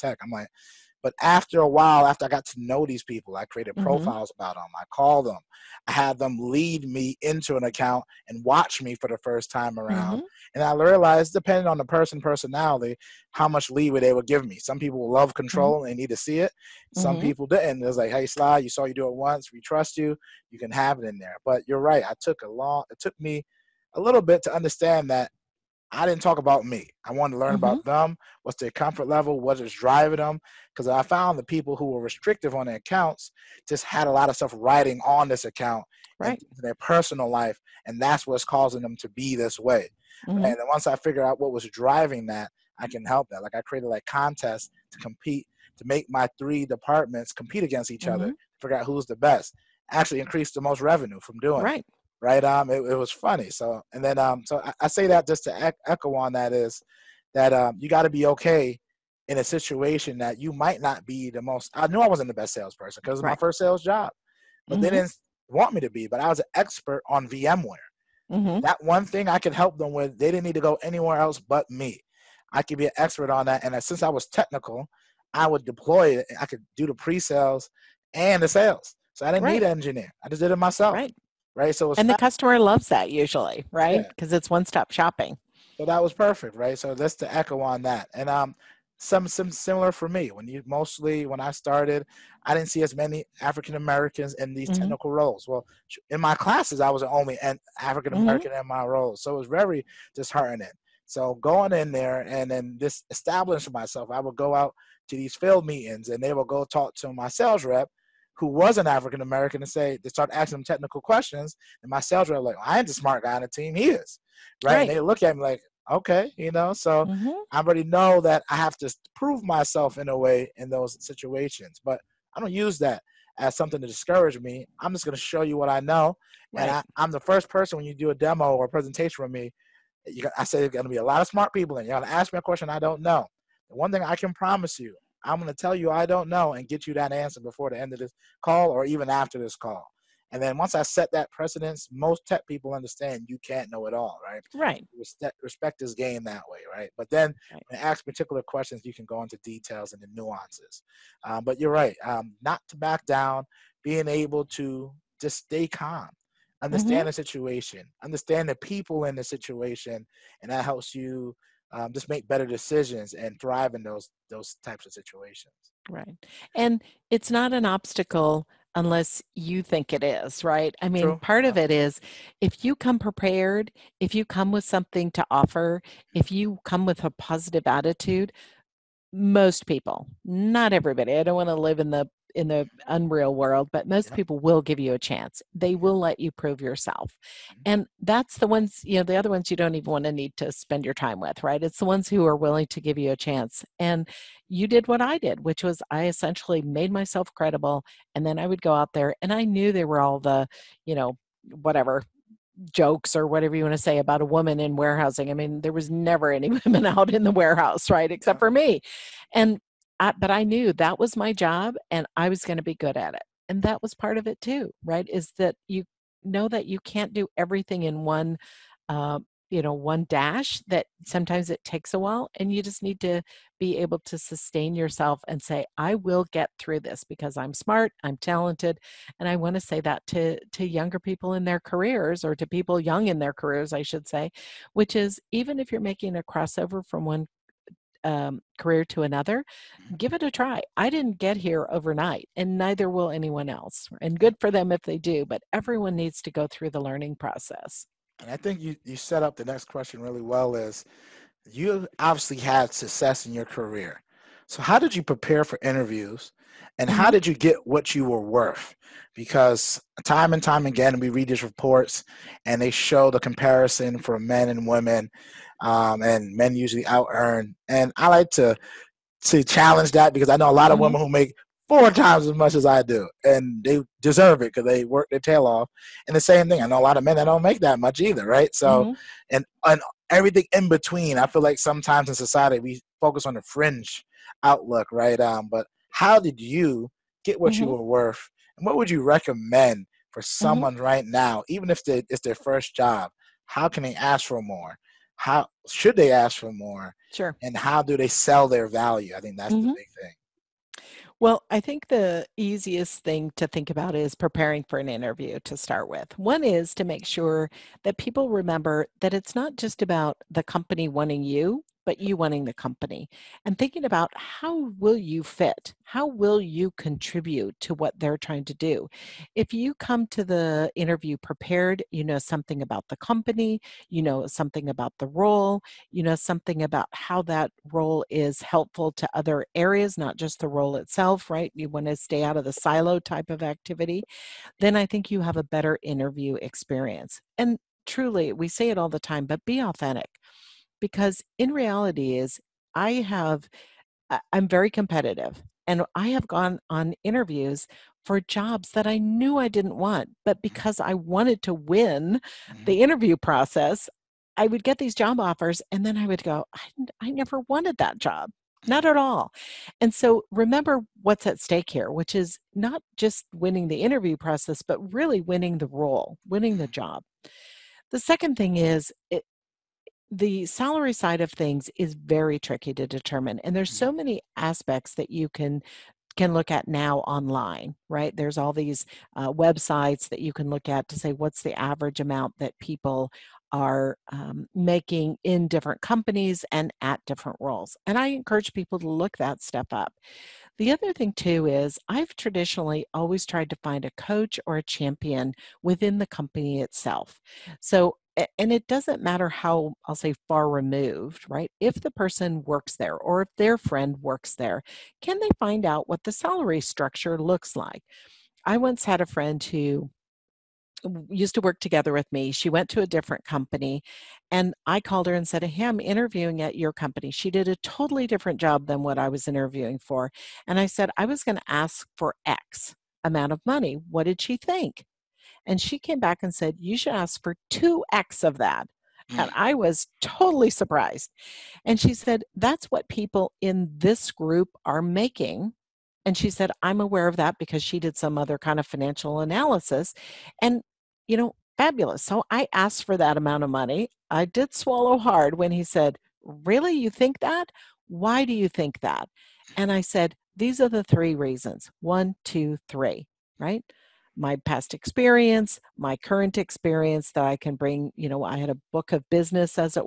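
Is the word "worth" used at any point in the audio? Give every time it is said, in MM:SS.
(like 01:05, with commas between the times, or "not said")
04:18, 04:47.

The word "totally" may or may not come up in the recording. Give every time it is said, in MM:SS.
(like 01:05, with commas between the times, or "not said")
06:57, 07:10.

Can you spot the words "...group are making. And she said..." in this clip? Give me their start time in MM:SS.
07:14.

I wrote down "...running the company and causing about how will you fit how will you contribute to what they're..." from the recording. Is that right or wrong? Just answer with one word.
wrong.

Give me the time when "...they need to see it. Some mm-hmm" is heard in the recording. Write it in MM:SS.
00:15.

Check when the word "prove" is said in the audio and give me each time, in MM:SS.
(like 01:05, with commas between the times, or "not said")
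01:59, 03:06.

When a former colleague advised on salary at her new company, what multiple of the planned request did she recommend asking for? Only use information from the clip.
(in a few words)
2x.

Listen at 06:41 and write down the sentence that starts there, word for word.
If the person works there or if their friend works there, can they find out what the salary structure looks like?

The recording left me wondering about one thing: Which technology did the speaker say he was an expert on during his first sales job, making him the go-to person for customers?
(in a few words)
VMware.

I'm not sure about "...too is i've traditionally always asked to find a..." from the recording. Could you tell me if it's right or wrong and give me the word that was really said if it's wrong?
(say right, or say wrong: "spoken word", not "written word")
wrong: "tried", not "asked".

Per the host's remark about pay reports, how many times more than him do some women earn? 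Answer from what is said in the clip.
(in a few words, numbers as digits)
4 times.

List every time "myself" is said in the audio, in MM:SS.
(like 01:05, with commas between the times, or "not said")
01:20, 01:43, 01:59, 03:16.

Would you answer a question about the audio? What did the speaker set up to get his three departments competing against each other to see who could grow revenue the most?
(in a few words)
Contests.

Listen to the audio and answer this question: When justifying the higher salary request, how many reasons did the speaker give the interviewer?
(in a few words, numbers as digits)
3.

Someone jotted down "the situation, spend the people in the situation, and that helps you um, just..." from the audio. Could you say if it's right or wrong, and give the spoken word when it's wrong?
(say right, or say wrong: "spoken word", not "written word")
wrong: "understand", not "spend".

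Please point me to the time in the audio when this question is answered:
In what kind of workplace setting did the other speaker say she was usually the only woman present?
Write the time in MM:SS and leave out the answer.
03:27.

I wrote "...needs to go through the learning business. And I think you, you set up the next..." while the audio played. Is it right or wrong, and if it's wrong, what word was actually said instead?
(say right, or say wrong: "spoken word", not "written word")
wrong: "process", not "business".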